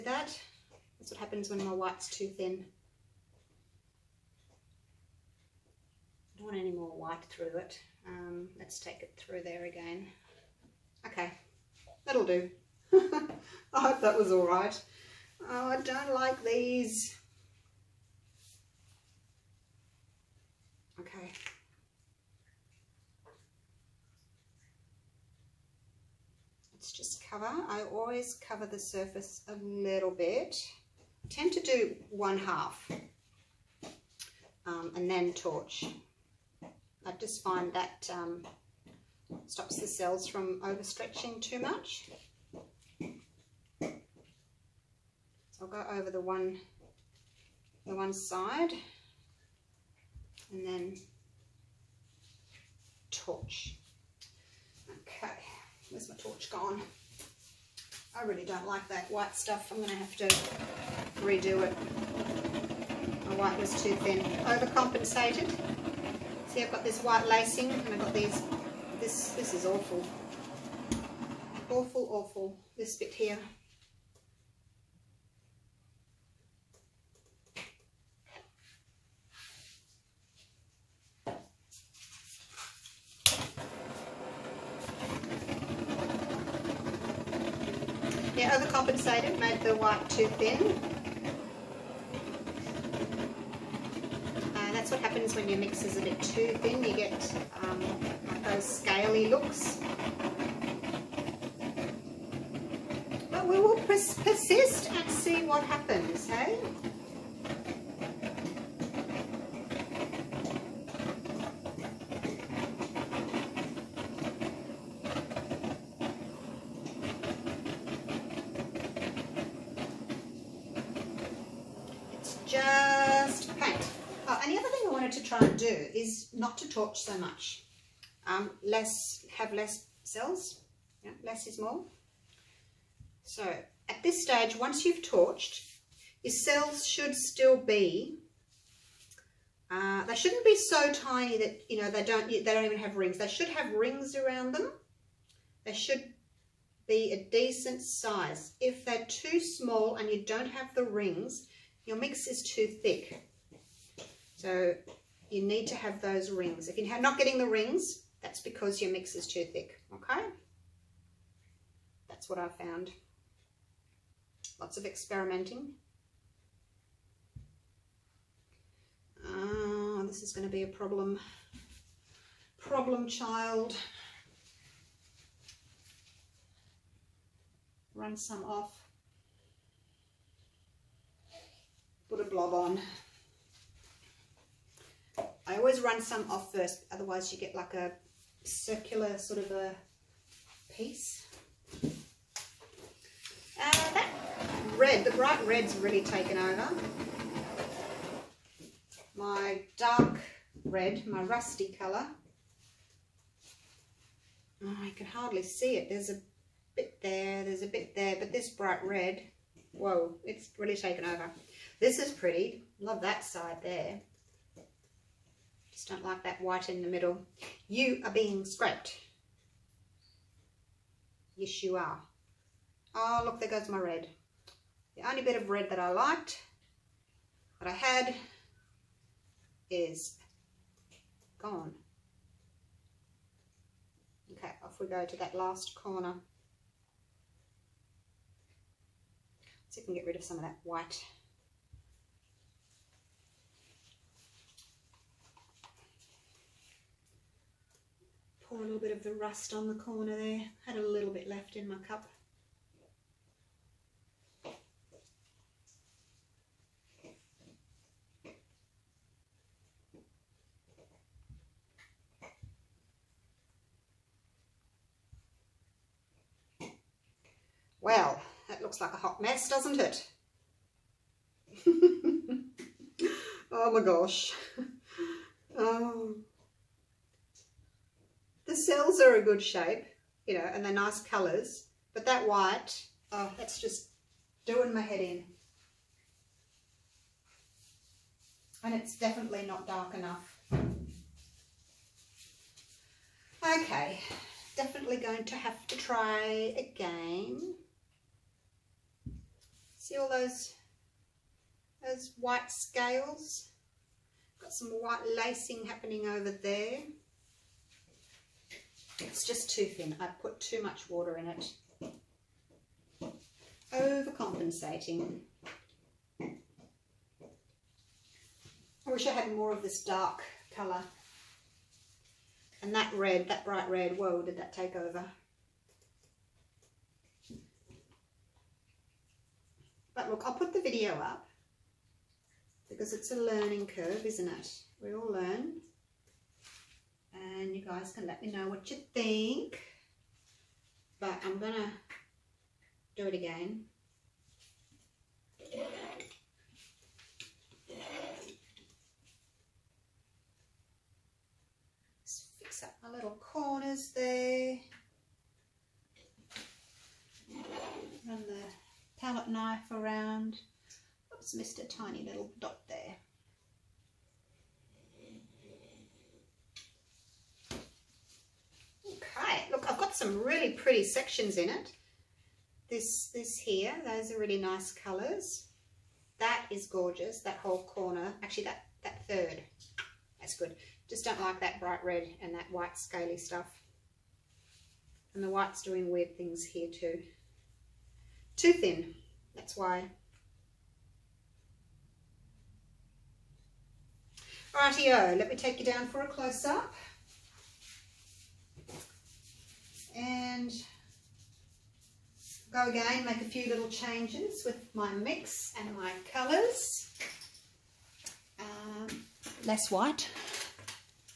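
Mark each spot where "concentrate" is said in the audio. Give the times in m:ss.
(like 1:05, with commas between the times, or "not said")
not said.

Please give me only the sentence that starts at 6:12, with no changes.
This, this here, those are really nice colours.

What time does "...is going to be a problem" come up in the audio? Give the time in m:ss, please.
2:50.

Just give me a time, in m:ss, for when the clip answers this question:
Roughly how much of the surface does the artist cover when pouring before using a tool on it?
0:32.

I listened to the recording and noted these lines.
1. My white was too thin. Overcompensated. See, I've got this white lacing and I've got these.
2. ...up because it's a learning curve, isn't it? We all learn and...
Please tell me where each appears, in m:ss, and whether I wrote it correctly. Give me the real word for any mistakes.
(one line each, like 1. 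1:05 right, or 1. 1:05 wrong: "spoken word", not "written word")
1. 1:03 right
2. 5:30 right.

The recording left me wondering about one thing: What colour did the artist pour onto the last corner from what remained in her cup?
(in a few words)
rust.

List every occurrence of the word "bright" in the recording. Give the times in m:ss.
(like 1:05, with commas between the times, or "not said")
3:15, 3:28, 5:23, 6:21.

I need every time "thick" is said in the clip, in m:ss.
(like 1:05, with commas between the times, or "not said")
2:32, 2:39.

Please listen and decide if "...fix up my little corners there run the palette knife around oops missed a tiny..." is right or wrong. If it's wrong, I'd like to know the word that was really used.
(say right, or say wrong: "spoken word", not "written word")
right.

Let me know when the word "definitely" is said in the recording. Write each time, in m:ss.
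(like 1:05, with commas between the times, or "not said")
4:48, 4:54.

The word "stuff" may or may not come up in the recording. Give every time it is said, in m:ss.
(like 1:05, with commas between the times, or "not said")
0:59, 6:23.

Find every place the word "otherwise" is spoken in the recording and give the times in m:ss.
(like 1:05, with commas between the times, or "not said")
3:06.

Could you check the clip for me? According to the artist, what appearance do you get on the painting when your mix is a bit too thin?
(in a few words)
scaly looks.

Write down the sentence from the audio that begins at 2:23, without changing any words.
They should have rings around them.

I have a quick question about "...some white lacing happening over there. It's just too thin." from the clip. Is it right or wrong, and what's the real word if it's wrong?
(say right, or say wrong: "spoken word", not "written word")
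right.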